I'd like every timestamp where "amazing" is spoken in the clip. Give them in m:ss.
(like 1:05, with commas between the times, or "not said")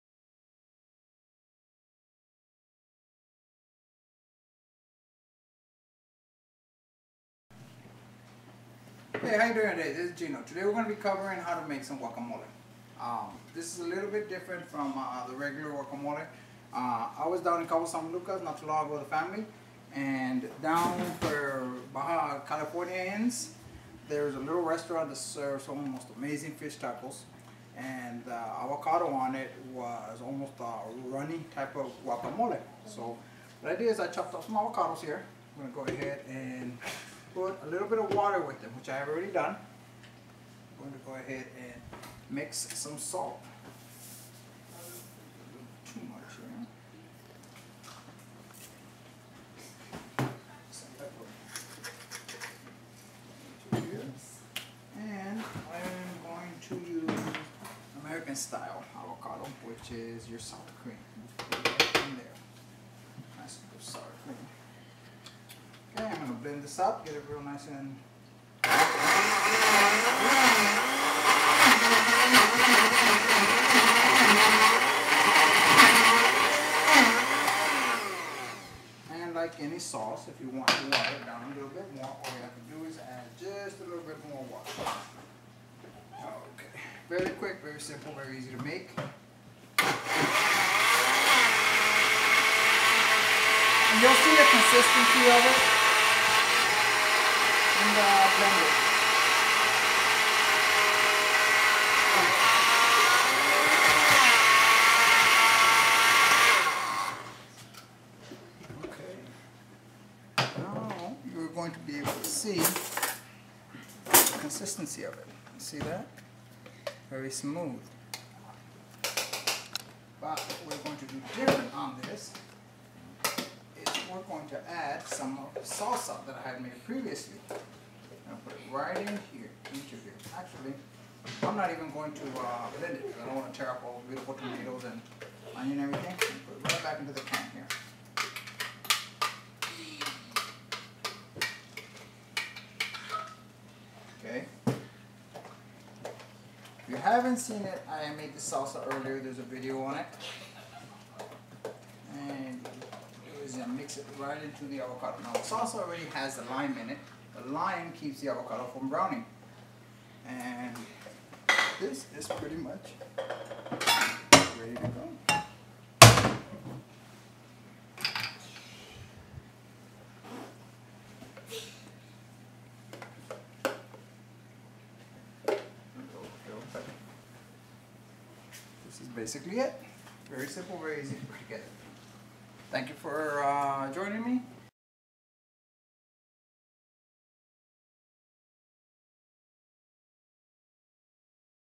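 0:26.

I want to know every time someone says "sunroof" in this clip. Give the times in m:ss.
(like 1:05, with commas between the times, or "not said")
not said.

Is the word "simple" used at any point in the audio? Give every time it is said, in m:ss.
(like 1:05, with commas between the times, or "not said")
1:27, 3:00.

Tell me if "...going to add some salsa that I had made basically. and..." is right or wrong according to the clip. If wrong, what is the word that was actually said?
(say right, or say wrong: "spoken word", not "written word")
wrong: "previously", not "basically".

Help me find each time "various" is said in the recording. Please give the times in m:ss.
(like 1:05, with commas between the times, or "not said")
not said.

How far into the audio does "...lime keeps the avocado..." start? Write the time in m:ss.
2:37.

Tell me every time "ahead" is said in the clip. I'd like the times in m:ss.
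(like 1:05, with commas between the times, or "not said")
0:35, 0:41.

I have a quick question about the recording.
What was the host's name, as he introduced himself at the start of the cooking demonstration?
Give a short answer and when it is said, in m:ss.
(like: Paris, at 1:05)
Gino, at 0:10.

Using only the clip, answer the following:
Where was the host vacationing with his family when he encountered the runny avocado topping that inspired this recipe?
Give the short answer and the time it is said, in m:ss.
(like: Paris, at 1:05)
Cabo San Lucas, at 0:17.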